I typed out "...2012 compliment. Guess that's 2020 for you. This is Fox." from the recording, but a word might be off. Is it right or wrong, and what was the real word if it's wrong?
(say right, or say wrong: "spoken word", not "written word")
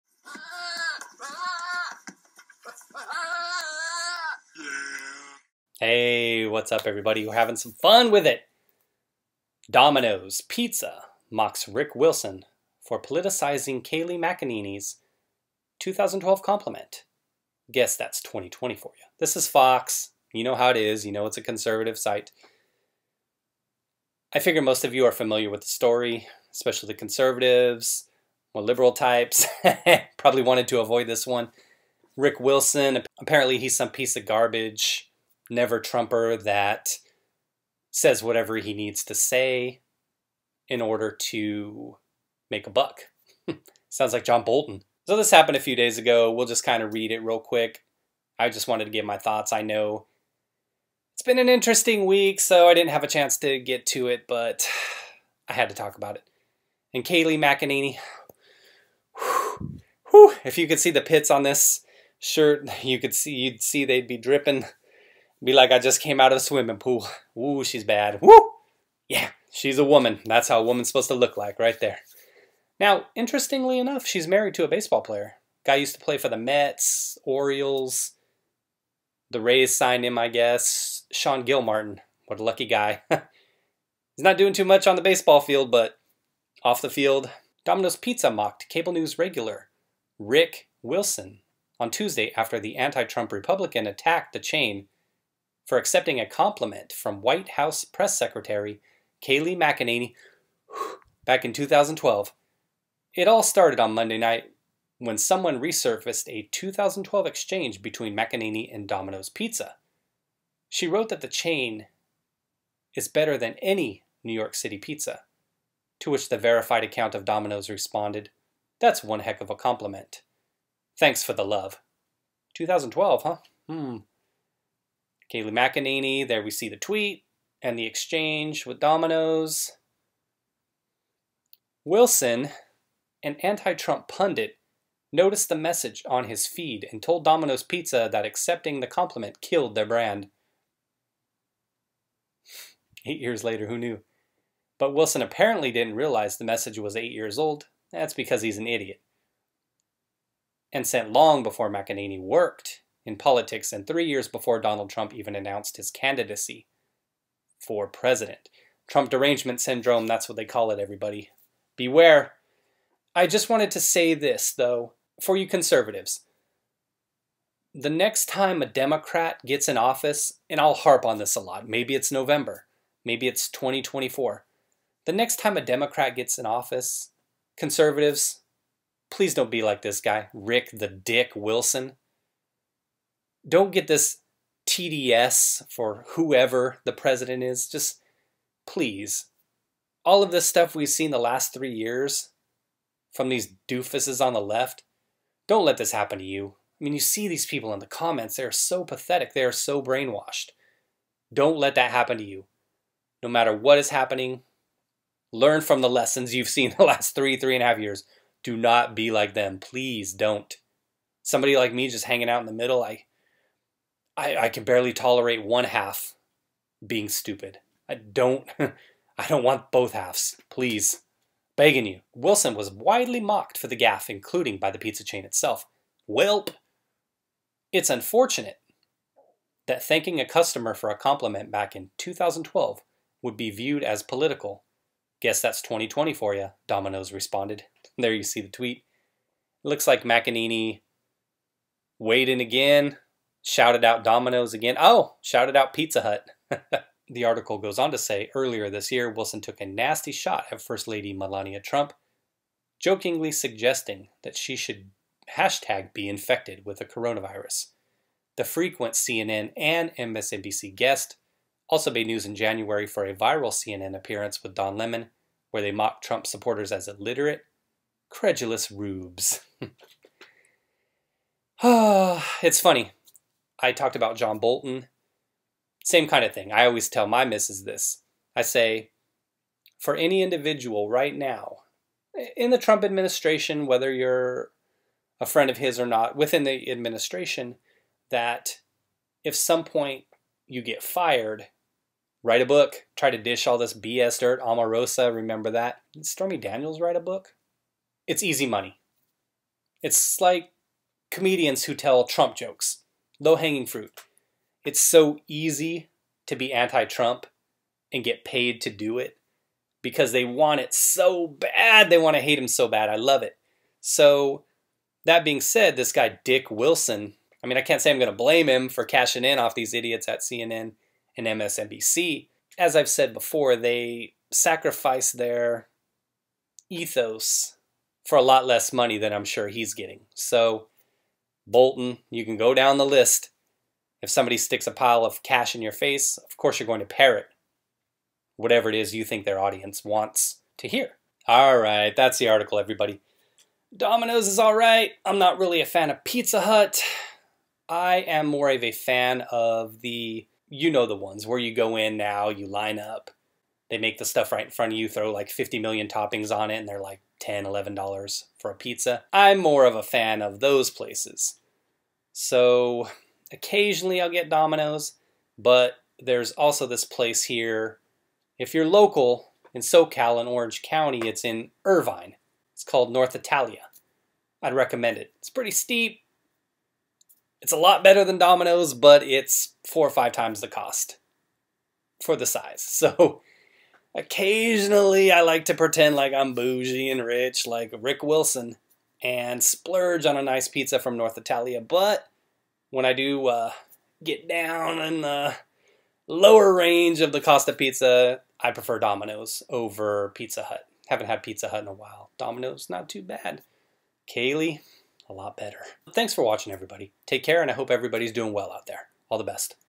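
right.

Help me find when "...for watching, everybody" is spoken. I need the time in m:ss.
6:46.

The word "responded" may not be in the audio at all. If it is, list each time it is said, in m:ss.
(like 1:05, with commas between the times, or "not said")
1:57, 3:57.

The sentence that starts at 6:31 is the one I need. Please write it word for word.
But when I do uh, get down in the lower range of the cost of pizza, I prefer Domino's over Pizza Hut.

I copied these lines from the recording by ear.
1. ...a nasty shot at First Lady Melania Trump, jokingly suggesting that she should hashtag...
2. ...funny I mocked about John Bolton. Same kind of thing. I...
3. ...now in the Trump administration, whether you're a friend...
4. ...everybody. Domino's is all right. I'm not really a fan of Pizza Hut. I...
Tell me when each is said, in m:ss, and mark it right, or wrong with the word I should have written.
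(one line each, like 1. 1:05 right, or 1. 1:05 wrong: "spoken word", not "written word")
1. 4:09 right
2. 4:32 wrong: "talked", not "mocked"
3. 4:41 right
4. 5:42 right.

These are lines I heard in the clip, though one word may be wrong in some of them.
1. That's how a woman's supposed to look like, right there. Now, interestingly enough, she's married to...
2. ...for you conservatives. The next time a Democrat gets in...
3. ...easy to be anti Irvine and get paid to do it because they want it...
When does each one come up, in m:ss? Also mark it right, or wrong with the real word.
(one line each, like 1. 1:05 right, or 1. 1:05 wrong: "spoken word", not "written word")
1. 1:10 right
2. 2:45 right
3. 5:05 wrong: "Trump", not "Irvine".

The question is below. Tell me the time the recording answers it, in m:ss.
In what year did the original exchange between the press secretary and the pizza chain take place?
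2:02.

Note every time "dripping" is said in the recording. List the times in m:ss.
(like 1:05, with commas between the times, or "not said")
1:04.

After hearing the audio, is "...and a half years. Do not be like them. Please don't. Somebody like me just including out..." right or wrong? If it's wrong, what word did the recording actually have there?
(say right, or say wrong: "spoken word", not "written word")
wrong: "hanging", not "including".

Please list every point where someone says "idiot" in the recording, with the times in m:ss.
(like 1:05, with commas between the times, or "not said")
2:28, 5:19.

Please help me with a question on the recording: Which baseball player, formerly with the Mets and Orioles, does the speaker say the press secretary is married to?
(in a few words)
Sean Gilmartin.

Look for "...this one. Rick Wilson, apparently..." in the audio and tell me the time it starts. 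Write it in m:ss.
0:31.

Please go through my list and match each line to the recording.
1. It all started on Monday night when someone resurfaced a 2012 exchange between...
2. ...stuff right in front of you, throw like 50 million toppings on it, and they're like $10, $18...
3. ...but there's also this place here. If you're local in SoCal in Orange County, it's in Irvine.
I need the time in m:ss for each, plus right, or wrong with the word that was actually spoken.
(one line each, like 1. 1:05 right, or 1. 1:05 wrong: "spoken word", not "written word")
1. 1:43 right
2. 5:54 wrong: "11", not "18"
3. 6:05 right.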